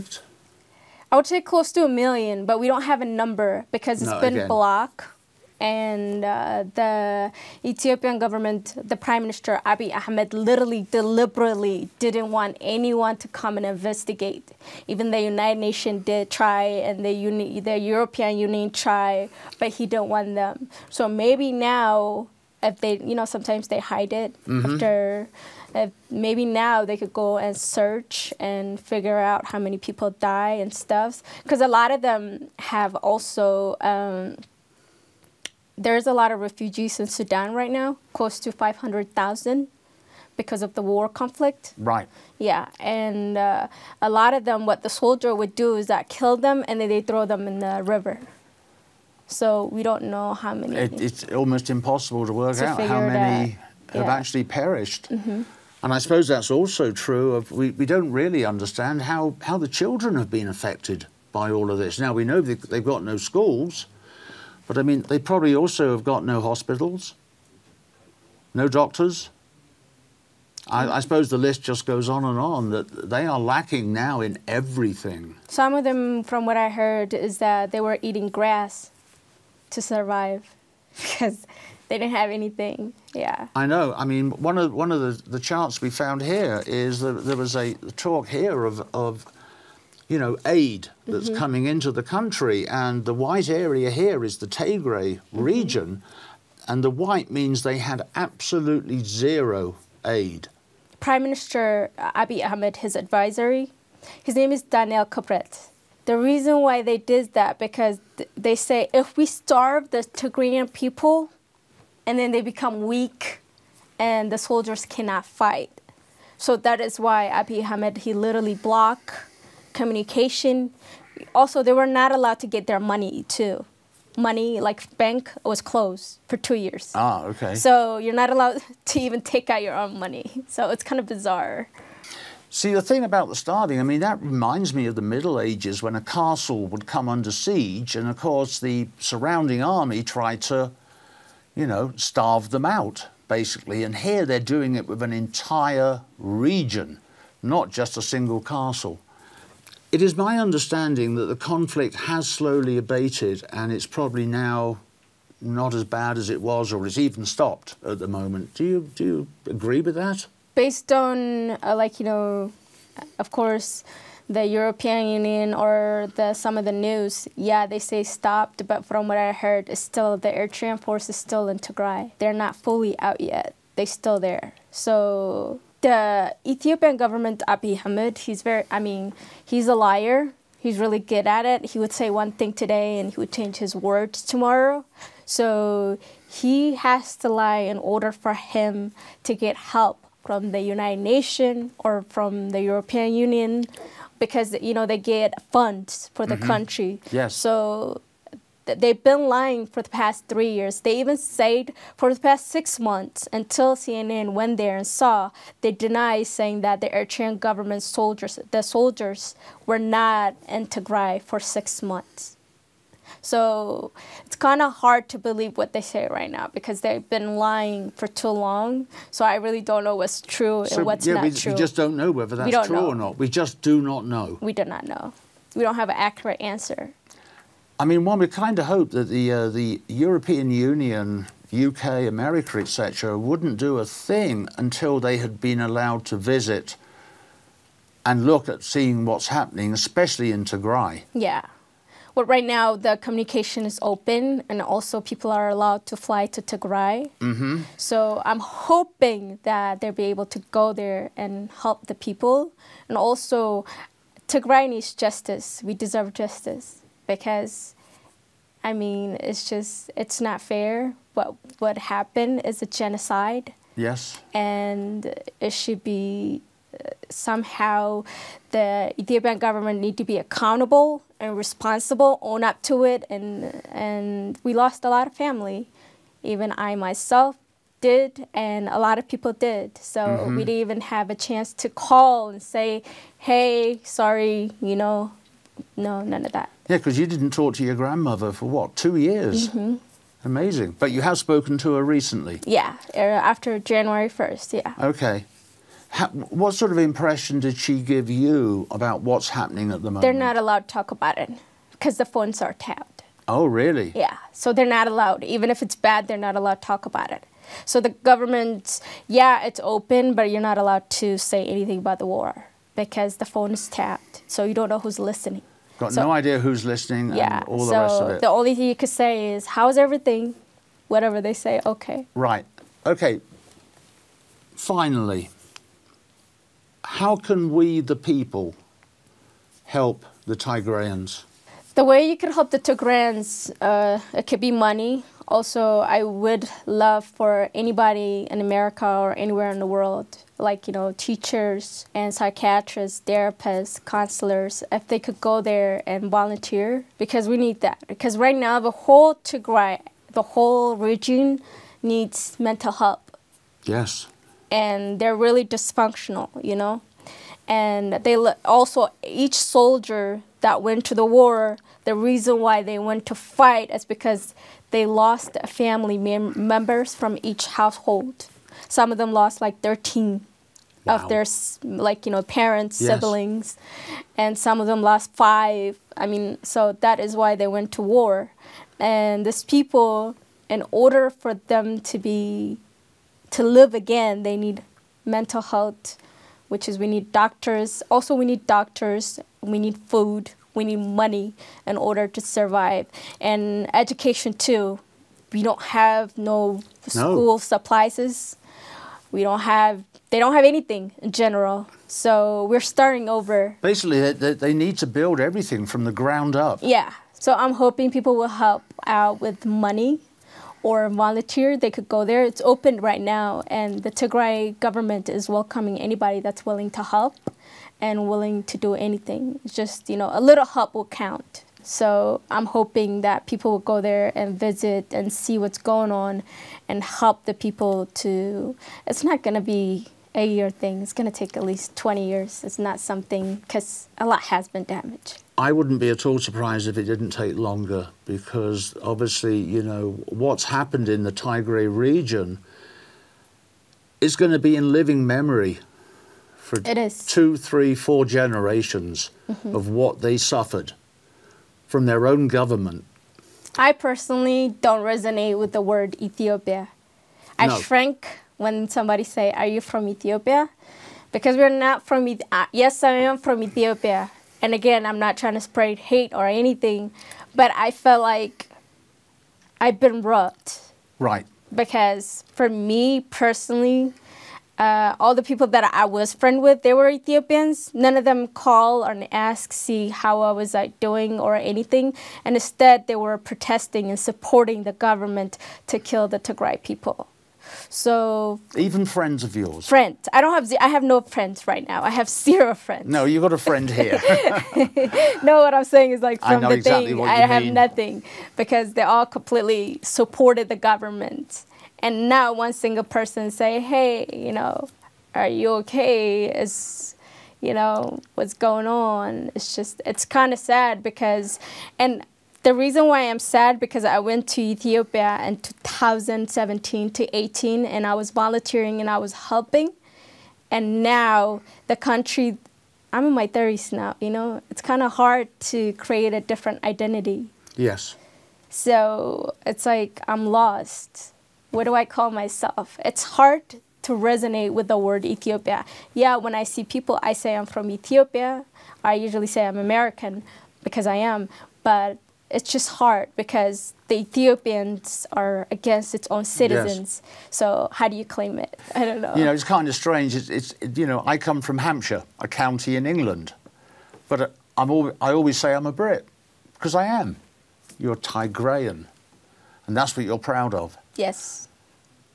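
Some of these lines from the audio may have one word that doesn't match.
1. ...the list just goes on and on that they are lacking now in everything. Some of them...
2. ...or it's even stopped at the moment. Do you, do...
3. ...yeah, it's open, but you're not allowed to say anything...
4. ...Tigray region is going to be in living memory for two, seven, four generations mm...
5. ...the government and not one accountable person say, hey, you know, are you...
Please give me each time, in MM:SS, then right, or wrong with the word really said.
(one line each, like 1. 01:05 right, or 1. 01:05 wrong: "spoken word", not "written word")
1. 01:11 right
2. 02:36 right
3. 05:09 right
4. 07:21 wrong: "three", not "seven"
5. 08:20 wrong: "single", not "accountable".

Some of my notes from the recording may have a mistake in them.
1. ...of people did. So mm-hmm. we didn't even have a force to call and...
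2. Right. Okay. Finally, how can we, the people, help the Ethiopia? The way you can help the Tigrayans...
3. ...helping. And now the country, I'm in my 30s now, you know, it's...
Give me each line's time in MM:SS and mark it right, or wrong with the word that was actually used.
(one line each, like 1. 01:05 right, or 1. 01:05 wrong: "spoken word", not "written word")
1. 04:38 wrong: "chance", not "force"
2. 05:22 wrong: "Tigrayans", not "Ethiopia"
3. 08:39 right.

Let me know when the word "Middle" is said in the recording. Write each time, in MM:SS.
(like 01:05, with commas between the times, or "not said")
02:15.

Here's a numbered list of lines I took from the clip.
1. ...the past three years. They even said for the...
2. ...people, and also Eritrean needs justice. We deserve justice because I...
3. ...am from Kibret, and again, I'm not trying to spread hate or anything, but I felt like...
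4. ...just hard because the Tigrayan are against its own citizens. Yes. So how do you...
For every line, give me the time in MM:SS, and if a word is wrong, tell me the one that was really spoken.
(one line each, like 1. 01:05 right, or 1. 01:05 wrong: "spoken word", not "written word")
1. 03:19 right
2. 04:12 wrong: "Tigray", not "Eritrean"
3. 07:43 wrong: "Ethiopia", not "Kibret"
4. 09:02 wrong: "Ethiopians", not "Tigrayan".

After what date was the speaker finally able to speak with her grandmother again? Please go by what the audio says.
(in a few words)
January 1st.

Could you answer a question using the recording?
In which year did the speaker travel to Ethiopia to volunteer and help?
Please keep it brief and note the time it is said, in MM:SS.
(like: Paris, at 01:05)
2017, at 08:35.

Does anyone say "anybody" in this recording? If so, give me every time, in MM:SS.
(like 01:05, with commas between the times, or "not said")
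05:37, 06:55.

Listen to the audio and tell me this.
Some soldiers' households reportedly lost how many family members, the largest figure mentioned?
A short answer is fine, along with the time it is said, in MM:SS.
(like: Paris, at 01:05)
13, at 06:09.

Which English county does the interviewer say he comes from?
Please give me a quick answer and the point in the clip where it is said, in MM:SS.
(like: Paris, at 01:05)
Hampshire, at 09:11.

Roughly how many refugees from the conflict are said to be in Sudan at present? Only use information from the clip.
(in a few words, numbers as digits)
500,000.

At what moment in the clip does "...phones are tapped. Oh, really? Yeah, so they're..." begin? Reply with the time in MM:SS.
05:02.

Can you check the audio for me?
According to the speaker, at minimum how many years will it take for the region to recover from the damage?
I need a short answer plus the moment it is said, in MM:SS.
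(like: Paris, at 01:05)
20 years, at 07:11.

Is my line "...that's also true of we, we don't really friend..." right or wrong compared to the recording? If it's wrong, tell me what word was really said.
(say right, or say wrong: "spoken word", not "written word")
wrong: "understand", not "friend".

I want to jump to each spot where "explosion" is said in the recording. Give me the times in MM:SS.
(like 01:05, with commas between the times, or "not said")
not said.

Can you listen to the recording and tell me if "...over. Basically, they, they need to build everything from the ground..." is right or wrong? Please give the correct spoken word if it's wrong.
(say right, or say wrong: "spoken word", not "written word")
right.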